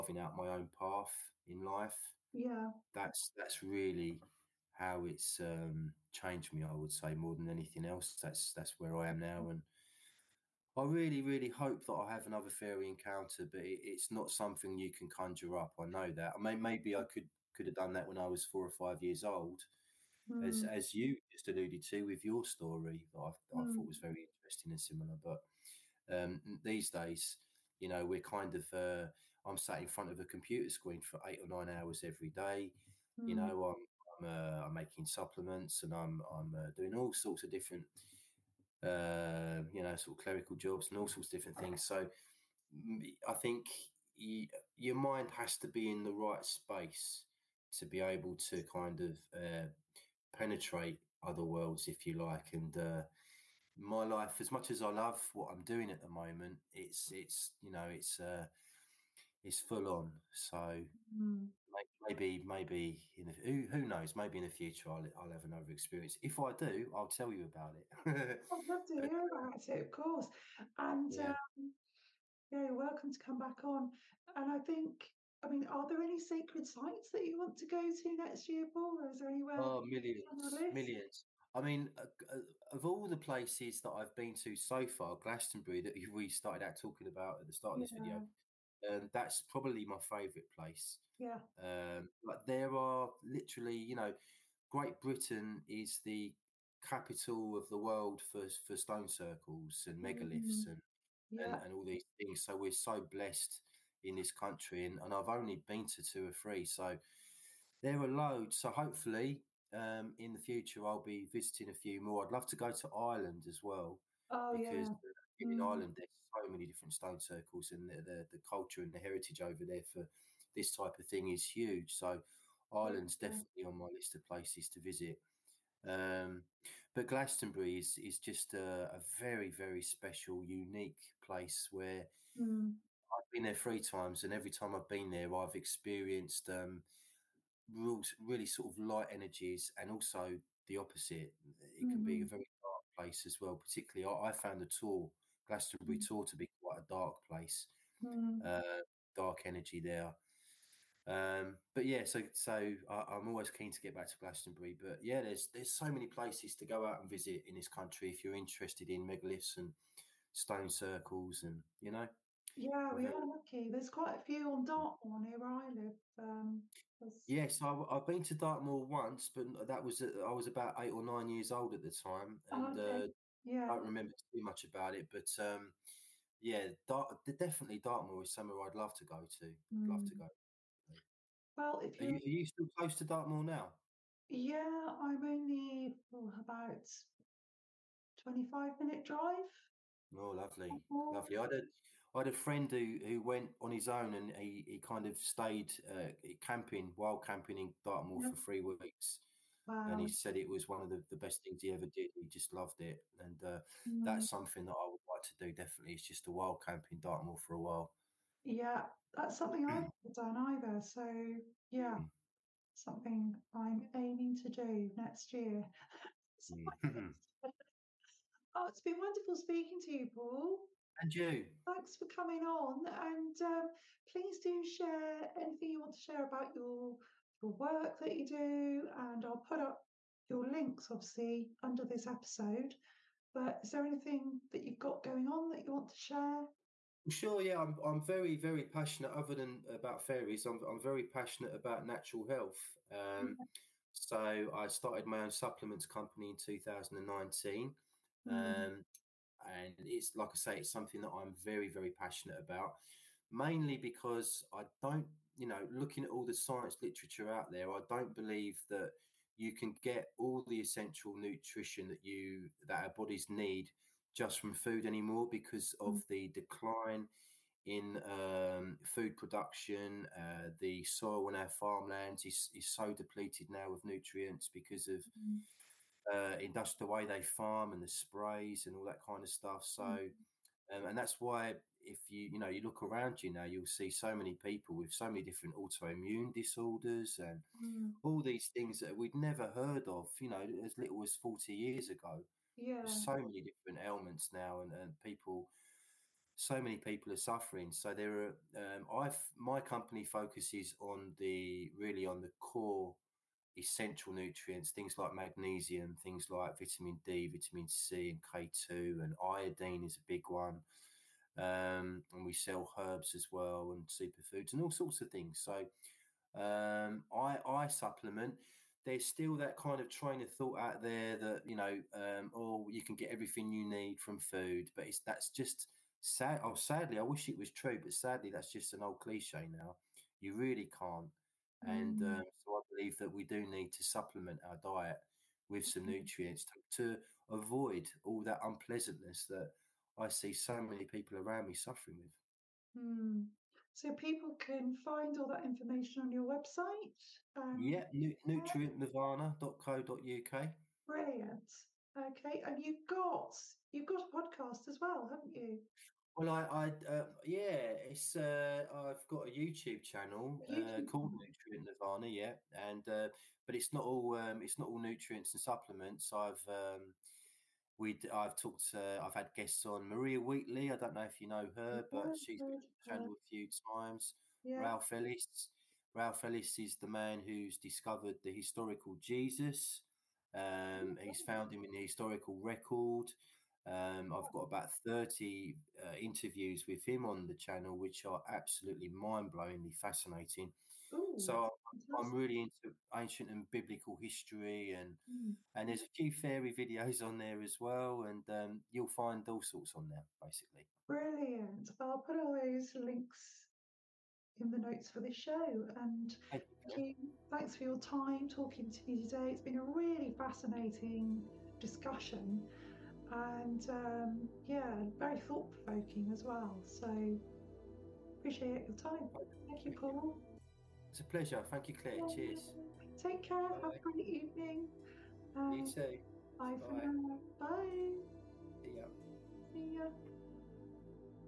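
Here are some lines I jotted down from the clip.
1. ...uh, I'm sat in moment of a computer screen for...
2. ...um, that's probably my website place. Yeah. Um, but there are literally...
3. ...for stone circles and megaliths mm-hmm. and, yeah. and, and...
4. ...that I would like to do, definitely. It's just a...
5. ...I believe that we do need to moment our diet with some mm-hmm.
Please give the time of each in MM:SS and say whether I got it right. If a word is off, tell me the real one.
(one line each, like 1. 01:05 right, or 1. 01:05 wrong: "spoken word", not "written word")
1. 00:28 wrong: "front", not "moment"
2. 01:29 wrong: "favorite", not "website"
3. 01:38 right
4. 03:24 right
5. 05:32 wrong: "supplement", not "moment".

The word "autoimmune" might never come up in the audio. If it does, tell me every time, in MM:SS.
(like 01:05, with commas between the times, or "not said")
04:45.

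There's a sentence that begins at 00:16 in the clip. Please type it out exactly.
I mean, maybe I could could have done that when I was four or five years old, mm.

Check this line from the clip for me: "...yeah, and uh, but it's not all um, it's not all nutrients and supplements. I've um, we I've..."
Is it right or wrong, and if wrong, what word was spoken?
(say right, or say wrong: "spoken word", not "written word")
right.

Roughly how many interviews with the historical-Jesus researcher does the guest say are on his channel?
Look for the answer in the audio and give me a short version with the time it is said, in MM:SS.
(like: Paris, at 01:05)
30, at 06:24.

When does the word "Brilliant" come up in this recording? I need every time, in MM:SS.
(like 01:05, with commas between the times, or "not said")
05:50, 06:40.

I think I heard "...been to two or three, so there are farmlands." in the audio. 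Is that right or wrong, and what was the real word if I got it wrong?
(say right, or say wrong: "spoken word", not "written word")
wrong: "loads", not "farmlands".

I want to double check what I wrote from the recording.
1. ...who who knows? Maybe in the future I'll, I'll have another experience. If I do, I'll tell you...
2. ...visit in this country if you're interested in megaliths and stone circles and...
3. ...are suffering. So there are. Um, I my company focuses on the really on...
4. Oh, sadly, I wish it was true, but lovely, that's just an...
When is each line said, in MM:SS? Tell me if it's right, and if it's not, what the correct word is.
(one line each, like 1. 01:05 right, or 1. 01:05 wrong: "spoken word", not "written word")
1. 01:03 right
2. 02:37 right
3. 04:57 right
4. 05:26 wrong: "sadly", not "lovely".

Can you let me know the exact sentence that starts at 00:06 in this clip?
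I would say more than anything else.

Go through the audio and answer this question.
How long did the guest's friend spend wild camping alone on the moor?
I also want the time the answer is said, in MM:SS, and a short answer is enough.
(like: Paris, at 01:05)
3 weeks, at 03:18.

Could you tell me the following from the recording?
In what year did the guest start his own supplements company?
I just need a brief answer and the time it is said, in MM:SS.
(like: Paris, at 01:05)
2019, at 04:06.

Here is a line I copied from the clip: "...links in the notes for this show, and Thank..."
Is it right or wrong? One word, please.
right.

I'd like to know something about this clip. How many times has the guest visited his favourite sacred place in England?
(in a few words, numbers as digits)
3.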